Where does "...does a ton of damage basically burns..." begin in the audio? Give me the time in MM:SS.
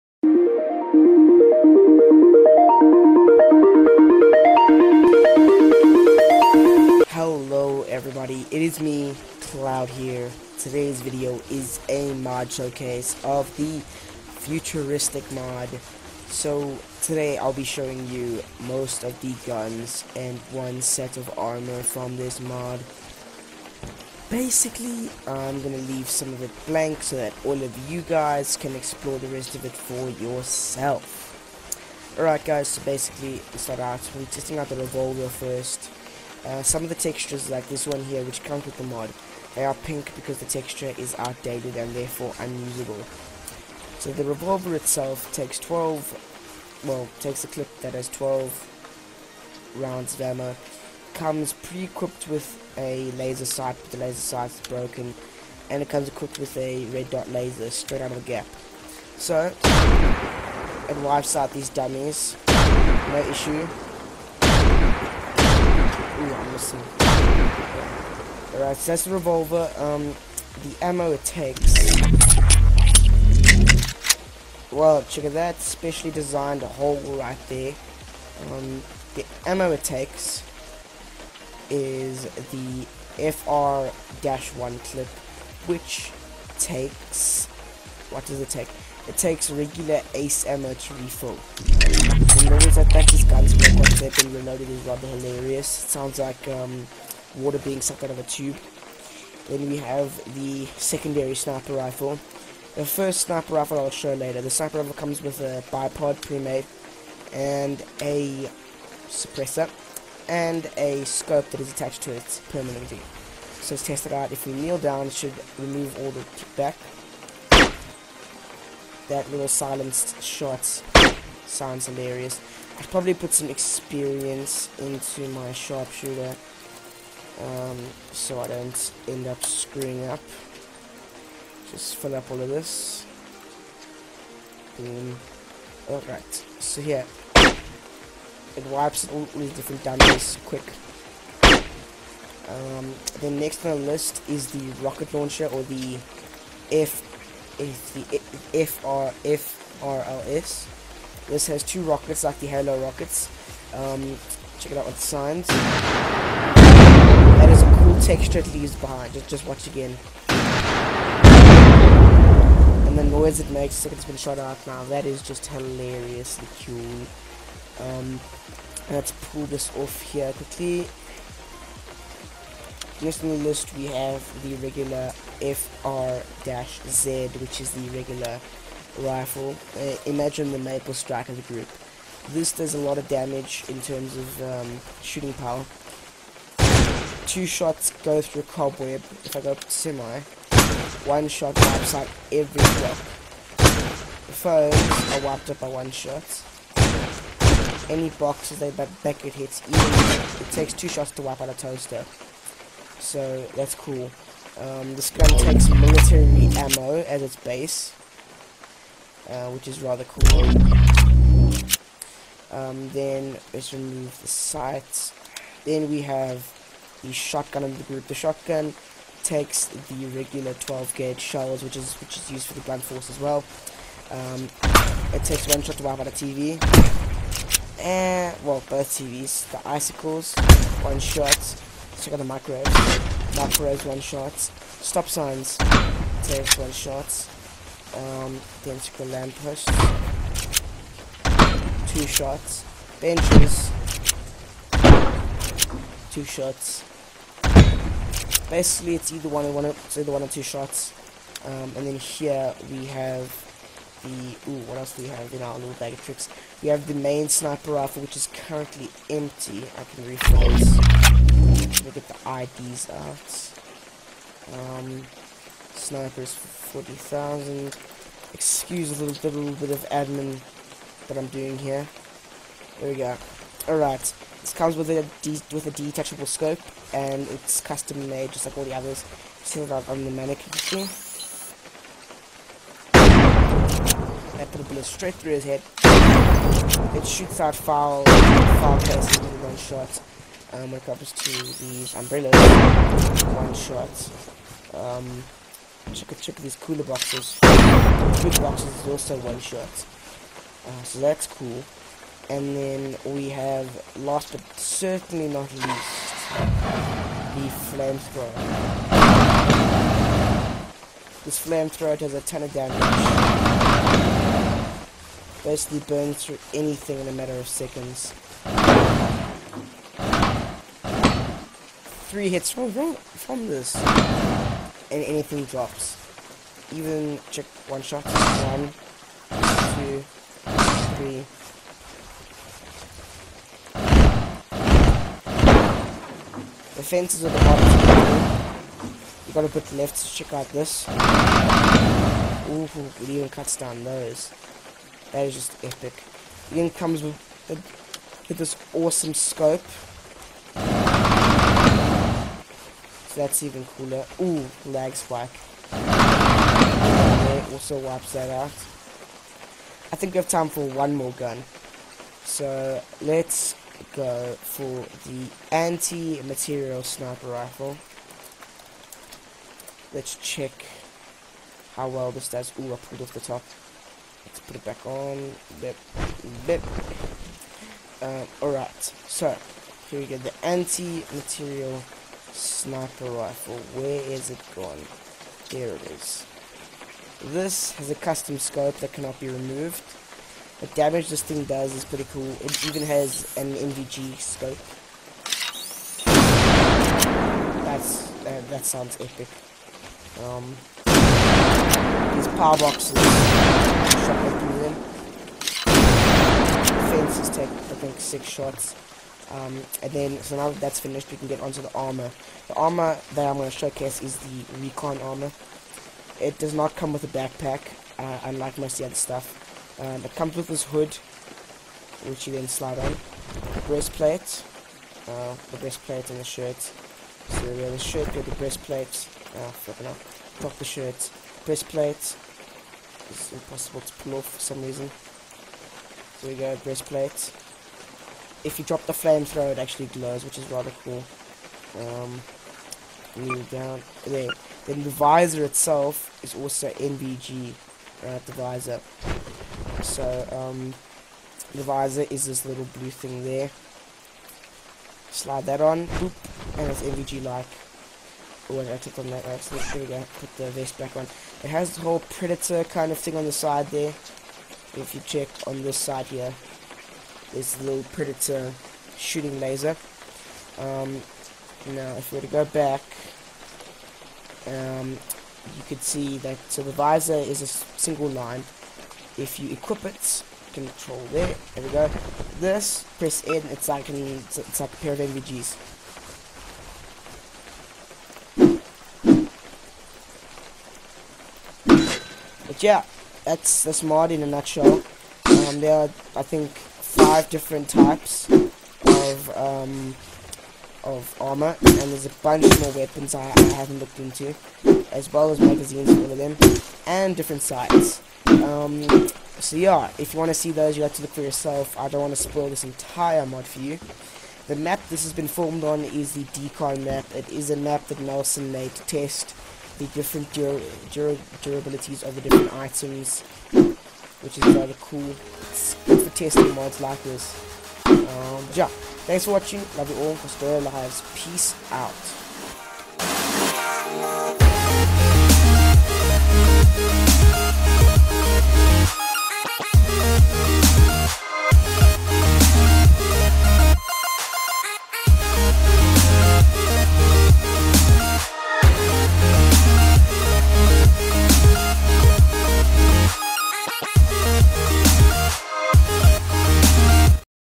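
05:11.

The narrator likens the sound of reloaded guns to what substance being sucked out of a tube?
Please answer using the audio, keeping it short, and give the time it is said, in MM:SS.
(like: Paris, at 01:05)
Water, at 01:37.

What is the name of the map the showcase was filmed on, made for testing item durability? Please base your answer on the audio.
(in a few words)
Decon map.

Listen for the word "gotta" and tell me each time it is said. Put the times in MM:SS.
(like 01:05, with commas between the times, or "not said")
05:39.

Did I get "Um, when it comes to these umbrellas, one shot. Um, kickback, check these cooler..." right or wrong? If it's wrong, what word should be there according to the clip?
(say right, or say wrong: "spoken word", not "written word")
wrong: "check", not "kickback".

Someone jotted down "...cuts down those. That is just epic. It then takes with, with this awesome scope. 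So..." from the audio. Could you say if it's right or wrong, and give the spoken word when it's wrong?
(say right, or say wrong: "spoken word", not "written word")
wrong: "comes", not "takes".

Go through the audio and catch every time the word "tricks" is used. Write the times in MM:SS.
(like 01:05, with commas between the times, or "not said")
04:16.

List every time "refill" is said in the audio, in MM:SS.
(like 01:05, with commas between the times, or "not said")
01:30, 04:20.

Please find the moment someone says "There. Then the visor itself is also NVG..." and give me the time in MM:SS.
07:24.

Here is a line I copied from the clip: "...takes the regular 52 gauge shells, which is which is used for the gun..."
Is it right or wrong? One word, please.
wrong.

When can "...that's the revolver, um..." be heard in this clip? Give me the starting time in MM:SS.
01:08.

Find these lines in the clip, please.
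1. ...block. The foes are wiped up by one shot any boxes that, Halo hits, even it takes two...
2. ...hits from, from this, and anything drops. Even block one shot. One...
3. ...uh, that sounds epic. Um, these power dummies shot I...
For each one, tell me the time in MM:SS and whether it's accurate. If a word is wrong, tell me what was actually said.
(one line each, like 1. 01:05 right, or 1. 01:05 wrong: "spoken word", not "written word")
1. 03:12 wrong: "Beckett", not "Halo"
2. 05:22 wrong: "check", not "block"
3. 06:38 wrong: "boxes", not "dummies".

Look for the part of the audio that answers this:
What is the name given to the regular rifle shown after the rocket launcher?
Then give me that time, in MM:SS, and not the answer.
02:55.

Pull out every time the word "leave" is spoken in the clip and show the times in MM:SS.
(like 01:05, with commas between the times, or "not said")
00:25, 02:38.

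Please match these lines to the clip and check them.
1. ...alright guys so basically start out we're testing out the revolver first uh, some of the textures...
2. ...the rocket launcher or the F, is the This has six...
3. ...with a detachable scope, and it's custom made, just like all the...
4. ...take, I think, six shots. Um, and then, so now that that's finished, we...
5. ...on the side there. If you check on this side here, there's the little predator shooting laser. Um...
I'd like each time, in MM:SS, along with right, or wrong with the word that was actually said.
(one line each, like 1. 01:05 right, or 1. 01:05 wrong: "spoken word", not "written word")
1. 00:32 right
2. 02:24 wrong: "two", not "six"
3. 04:35 right
4. 06:47 right
5. 07:43 right.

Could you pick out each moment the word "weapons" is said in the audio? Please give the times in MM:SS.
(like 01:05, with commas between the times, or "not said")
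08:22.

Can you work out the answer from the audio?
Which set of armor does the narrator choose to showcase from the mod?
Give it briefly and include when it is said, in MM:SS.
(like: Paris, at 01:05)
Recon armor, at 06:54.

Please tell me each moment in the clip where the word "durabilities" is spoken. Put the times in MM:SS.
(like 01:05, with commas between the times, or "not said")
08:41.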